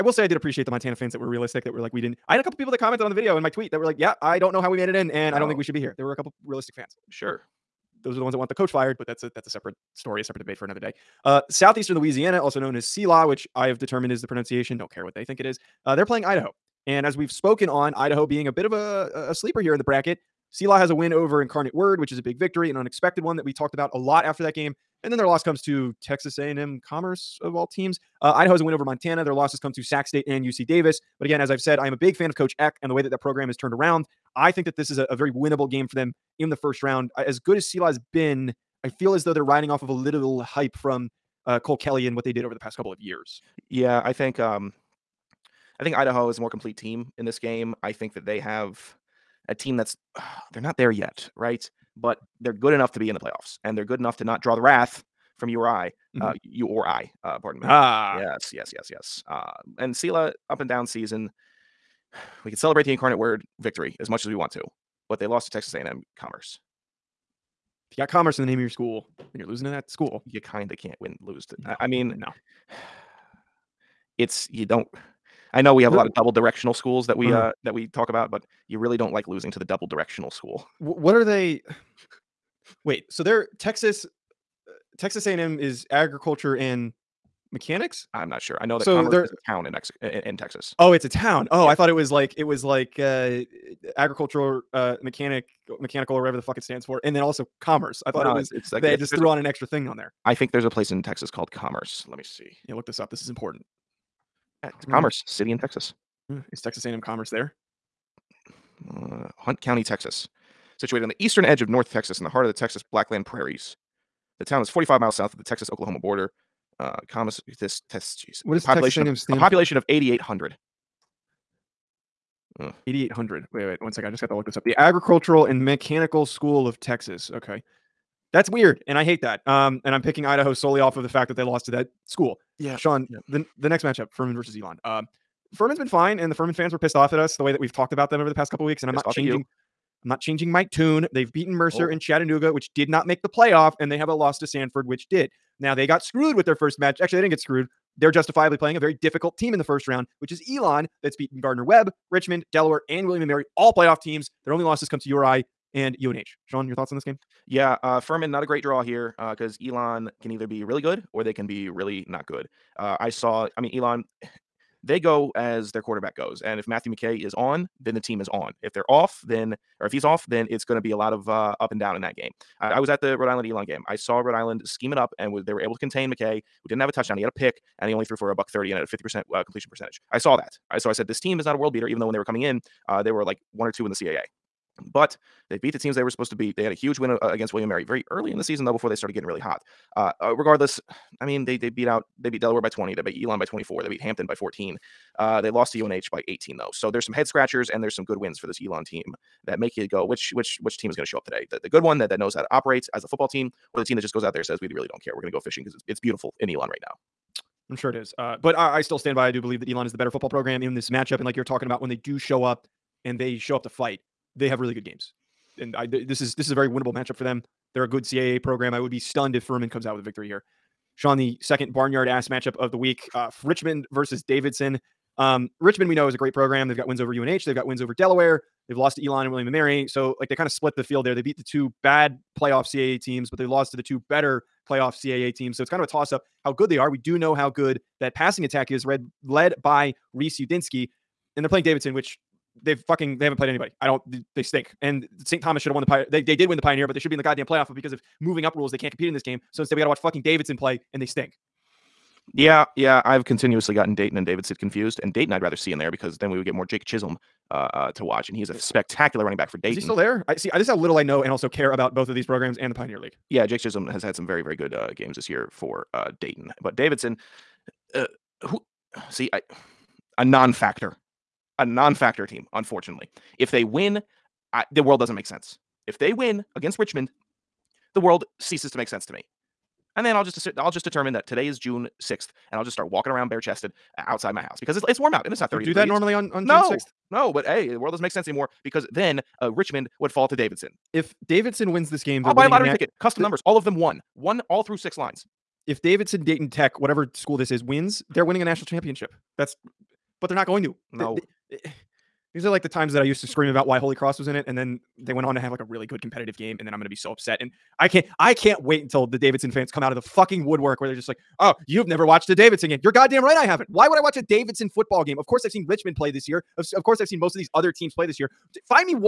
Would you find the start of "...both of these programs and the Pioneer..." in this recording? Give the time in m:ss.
4:21.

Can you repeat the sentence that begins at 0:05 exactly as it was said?
There were a couple realistic fans.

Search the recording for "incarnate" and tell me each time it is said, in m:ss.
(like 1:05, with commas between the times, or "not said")
0:21, 1:02.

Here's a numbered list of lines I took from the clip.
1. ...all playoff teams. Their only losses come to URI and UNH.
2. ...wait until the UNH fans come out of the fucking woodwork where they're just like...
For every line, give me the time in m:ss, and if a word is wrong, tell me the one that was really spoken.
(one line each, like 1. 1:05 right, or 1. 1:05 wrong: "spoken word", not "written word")
1. 2:33 right
2. 5:08 wrong: "Davidson", not "UNH".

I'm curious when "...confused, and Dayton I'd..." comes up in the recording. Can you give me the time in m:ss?
4:14.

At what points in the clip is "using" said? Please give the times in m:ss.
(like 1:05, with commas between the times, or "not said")
not said.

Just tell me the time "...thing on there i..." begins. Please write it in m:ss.
1:39.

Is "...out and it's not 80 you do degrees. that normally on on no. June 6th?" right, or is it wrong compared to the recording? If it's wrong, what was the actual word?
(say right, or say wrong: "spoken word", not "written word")
wrong: "30", not "80".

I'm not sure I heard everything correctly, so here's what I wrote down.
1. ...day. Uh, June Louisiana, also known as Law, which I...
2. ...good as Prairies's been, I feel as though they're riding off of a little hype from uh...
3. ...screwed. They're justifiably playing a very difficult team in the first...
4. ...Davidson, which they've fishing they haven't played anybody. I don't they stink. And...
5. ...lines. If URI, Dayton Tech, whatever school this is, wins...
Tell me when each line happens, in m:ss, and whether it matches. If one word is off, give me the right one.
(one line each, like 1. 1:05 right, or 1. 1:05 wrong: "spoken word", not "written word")
1. 0:10 wrong: "Southeastern", not "June"
2. 0:37 wrong: "Sela", not "Prairies"
3. 2:27 right
4. 4:01 wrong: "fucking", not "fishing"
5. 4:54 wrong: "Davidson", not "URI".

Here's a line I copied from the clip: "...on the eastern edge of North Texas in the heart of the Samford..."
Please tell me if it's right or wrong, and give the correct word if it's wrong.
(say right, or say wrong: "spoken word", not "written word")
wrong: "Texas", not "Samford".